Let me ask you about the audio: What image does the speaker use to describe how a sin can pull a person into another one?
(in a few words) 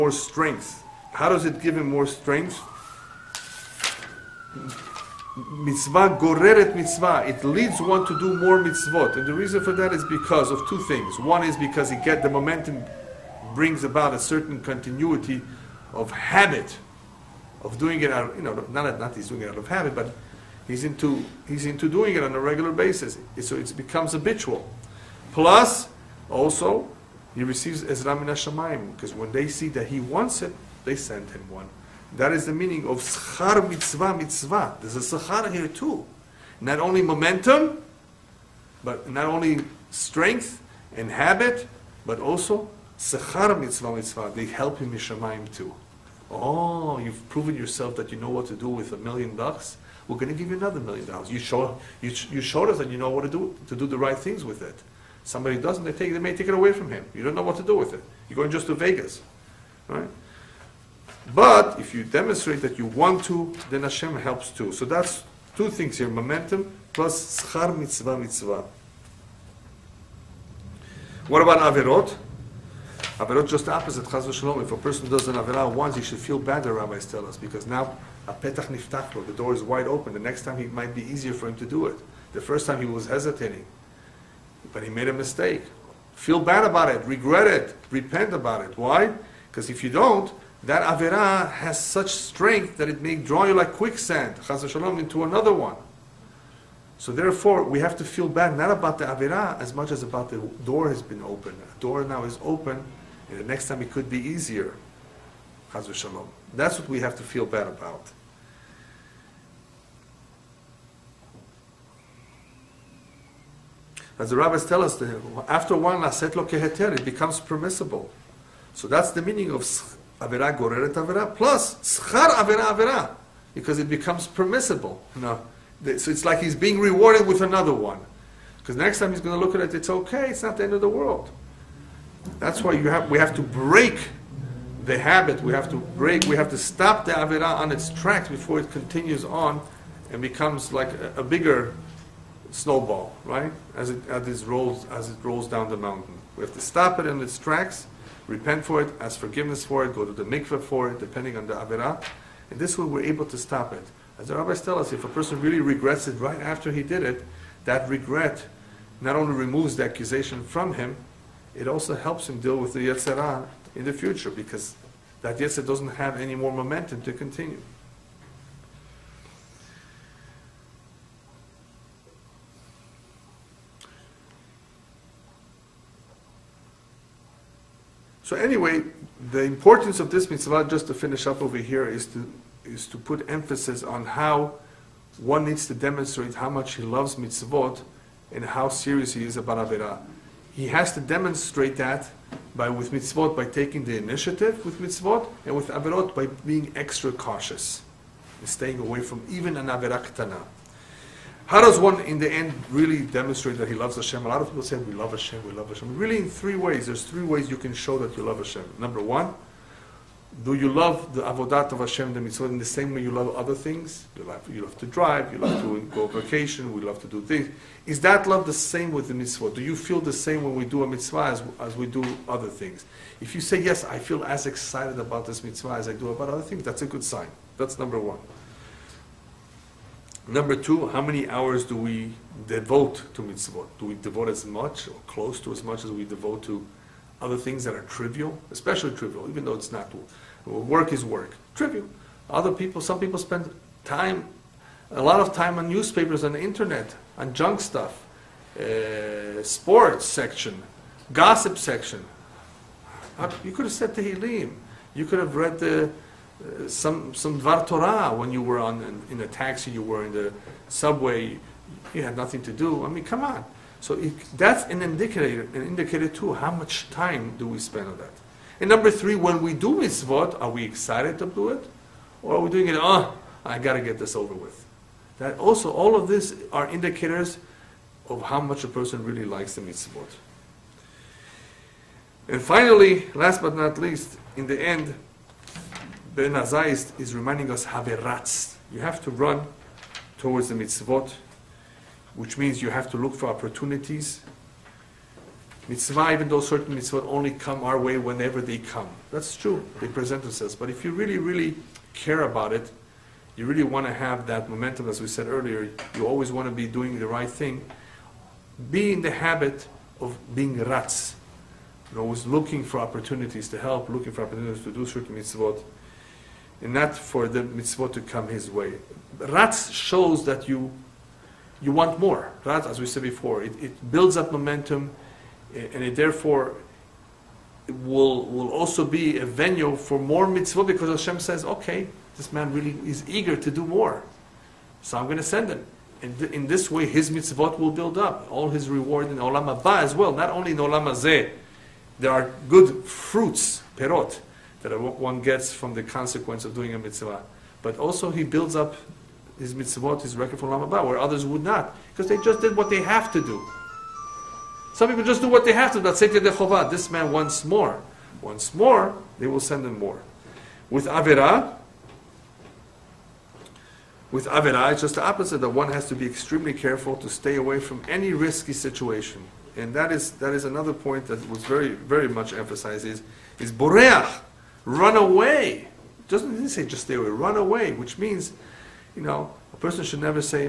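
quicksand.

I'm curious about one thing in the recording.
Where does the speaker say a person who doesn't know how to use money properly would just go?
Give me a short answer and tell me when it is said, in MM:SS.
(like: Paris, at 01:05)
Vegas, at 00:58.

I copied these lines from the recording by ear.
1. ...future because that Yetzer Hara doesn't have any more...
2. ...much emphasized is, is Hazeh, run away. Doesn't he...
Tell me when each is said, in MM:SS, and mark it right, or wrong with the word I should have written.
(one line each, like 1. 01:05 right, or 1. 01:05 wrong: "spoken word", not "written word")
1. 02:43 right
2. 06:12 wrong: "Boreach", not "Hazeh".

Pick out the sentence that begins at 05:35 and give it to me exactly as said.
And th- in this way, his mitzvot will build up.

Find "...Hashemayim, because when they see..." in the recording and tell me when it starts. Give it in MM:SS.
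00:28.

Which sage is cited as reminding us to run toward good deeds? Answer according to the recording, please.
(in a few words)
Ben Azai.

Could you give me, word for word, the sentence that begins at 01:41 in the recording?
The door now is open and the next time it could be easier.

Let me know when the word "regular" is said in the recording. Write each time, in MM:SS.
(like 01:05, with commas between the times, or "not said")
00:22.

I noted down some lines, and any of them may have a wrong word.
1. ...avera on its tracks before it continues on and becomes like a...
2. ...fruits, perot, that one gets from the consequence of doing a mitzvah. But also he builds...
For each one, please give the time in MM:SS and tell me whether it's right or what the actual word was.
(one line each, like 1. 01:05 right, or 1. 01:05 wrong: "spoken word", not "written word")
1. 02:17 right
2. 05:42 right.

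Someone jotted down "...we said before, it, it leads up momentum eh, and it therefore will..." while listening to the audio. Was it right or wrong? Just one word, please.
wrong.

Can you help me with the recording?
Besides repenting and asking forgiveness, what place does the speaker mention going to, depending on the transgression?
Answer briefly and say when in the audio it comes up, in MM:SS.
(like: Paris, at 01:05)
the mikveh, at 02:30.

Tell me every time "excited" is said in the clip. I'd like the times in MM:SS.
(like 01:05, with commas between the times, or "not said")
03:44, 04:30.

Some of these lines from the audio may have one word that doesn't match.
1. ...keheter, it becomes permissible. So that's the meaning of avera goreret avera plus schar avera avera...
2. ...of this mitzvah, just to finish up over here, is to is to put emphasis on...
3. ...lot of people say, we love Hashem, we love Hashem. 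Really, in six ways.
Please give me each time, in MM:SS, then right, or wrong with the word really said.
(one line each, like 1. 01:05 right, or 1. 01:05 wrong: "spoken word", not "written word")
1. 01:56 right
2. 02:59 right
3. 03:24 wrong: "three", not "six".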